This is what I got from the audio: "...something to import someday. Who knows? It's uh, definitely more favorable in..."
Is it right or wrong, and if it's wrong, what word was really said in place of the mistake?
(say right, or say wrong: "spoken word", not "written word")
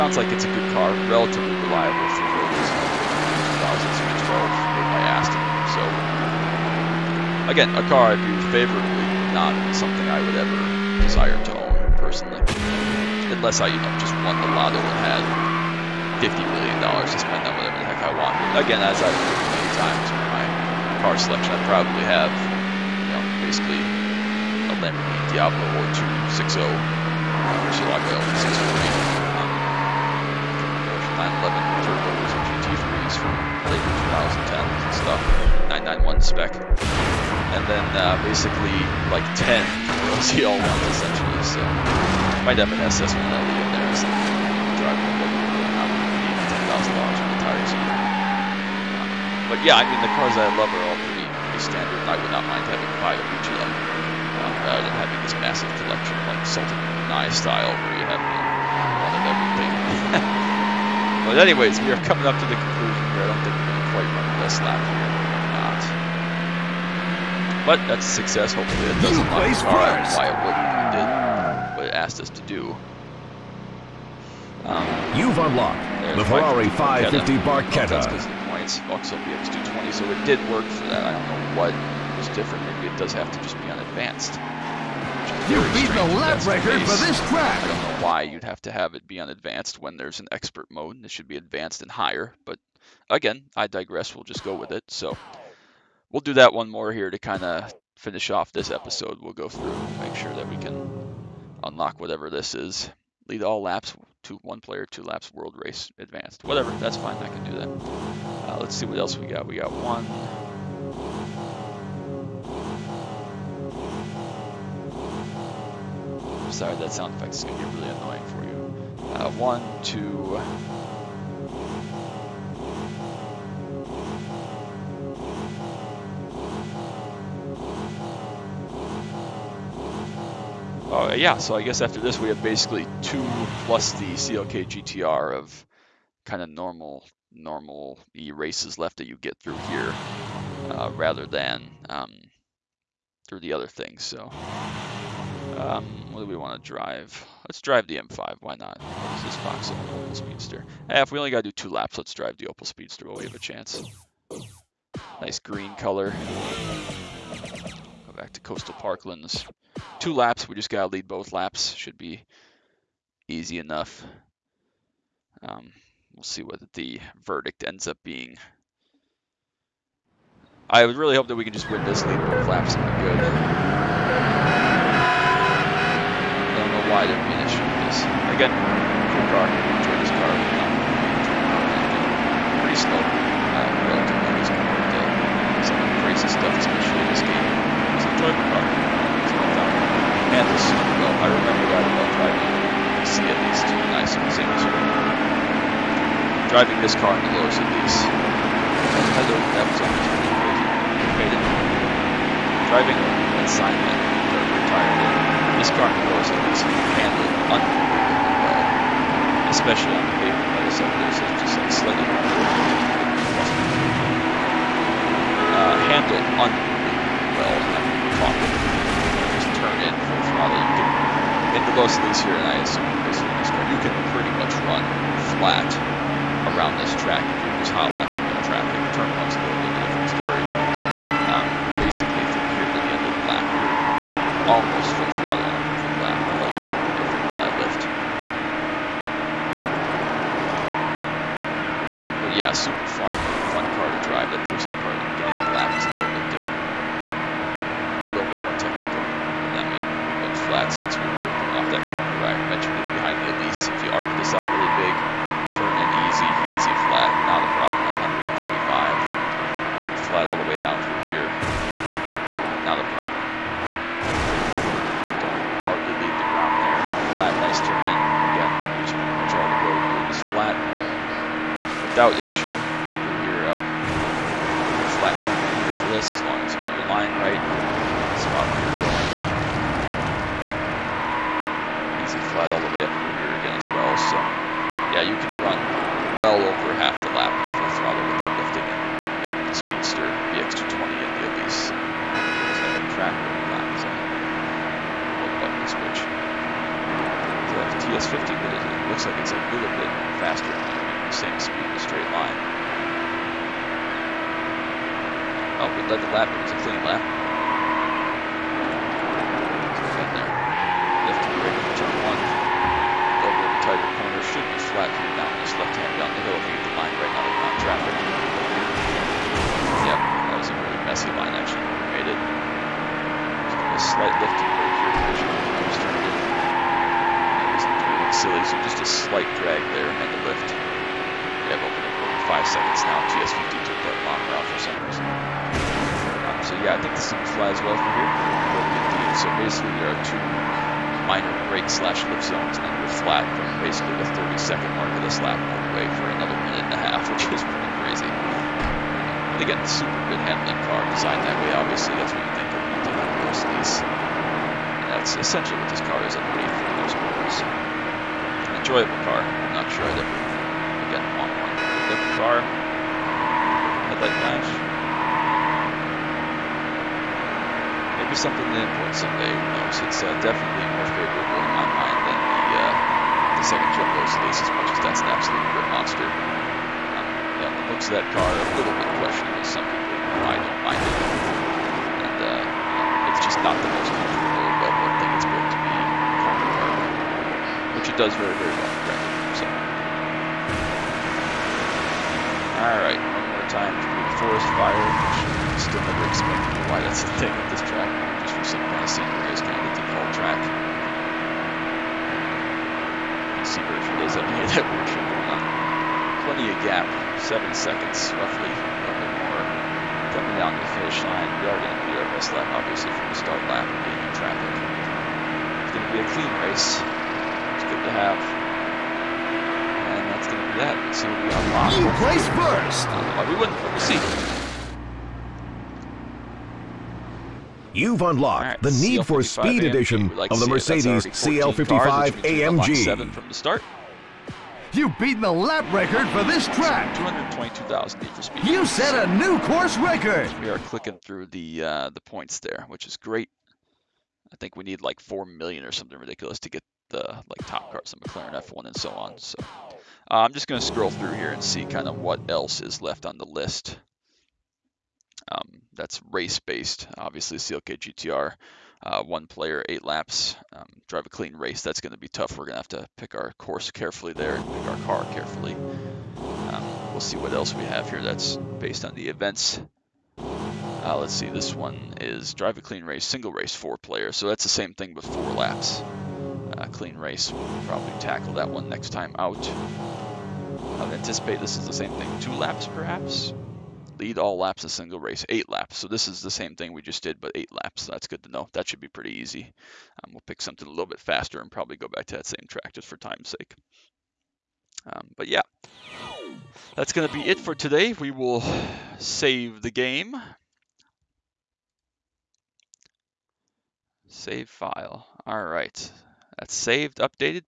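right.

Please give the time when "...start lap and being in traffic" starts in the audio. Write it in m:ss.
6:53.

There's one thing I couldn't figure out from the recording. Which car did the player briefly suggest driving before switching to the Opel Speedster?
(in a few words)
M5.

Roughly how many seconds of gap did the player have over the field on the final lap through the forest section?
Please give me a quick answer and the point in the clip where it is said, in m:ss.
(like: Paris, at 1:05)
7, at 6:47.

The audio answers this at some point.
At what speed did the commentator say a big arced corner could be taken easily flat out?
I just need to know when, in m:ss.
4:18.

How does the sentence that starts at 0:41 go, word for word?
So might have an SS1 LE in there.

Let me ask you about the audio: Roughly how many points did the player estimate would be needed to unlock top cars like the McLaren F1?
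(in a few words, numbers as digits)
4 million.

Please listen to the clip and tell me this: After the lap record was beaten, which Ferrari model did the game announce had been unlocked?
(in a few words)
Ferrari 550 Barchetta.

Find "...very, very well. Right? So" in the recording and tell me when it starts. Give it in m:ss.
6:28.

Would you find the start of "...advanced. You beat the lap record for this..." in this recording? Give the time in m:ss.
1:23.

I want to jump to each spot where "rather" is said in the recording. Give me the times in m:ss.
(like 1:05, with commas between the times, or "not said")
0:54, 2:20.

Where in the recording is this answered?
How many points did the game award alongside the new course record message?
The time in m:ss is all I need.
7:16.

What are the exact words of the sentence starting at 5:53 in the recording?
And that's essentially what this car is underneath for the most part.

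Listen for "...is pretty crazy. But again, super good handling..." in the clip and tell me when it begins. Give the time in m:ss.
5:47.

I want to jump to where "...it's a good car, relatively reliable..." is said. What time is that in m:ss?
0:00.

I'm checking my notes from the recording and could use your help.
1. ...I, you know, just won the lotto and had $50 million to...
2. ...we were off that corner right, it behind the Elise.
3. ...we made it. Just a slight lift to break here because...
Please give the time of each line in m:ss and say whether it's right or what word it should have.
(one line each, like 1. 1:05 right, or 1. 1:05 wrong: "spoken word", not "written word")
1. 0:13 right
2. 4:10 right
3. 5:21 right.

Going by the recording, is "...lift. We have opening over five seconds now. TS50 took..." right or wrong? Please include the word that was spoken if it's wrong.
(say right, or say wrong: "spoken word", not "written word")
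right.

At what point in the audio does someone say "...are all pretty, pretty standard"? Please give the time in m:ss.
0:50.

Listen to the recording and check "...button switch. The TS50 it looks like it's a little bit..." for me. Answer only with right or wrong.
right.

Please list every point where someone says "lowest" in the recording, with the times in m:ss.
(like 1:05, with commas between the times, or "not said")
3:17, 3:26, 3:41.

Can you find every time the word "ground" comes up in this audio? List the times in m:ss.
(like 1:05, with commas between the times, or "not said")
4:26.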